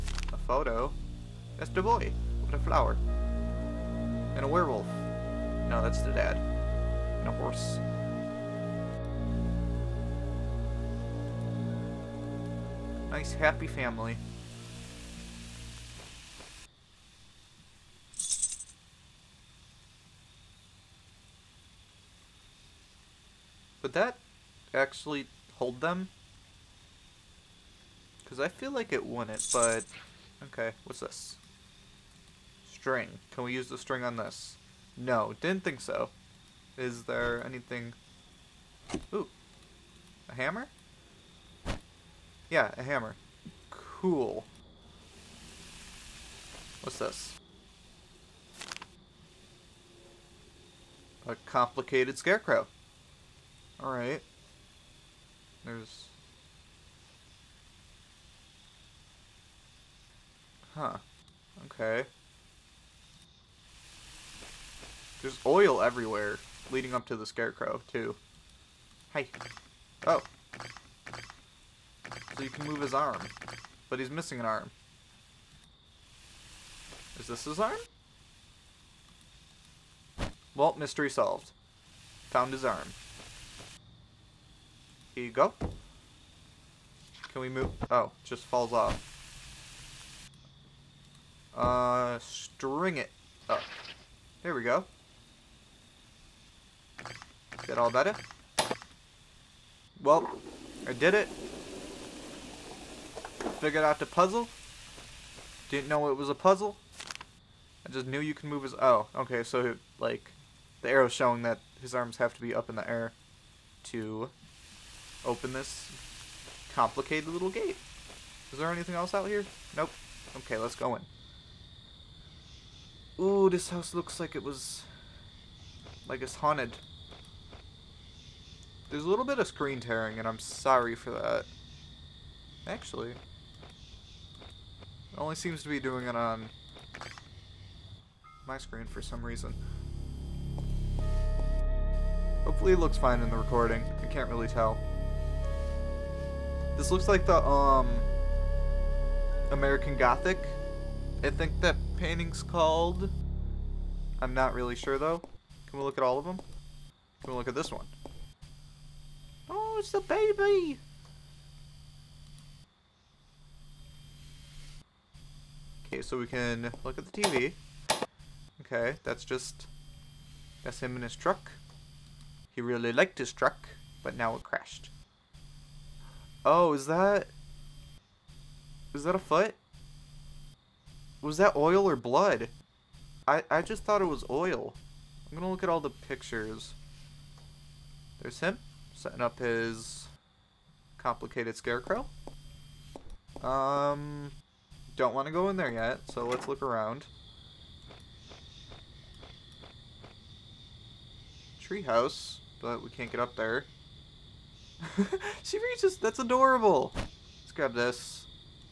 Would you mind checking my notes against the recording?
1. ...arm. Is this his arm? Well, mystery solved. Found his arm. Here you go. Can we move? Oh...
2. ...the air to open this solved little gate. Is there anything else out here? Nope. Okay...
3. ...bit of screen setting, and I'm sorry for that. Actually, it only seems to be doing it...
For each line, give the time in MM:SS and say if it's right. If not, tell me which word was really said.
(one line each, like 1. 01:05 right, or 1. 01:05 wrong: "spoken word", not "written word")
1. 01:14 right
2. 01:52 wrong: "complicated", not "solved"
3. 02:09 wrong: "tearing", not "setting".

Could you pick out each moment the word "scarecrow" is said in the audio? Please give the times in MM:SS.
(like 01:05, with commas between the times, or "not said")
00:52, 01:07, 03:11.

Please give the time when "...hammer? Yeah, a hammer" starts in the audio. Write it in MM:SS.
00:40.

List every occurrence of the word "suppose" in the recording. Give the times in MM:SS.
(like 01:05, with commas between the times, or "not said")
not said.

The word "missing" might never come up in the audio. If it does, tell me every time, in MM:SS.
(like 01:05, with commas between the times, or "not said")
01:14.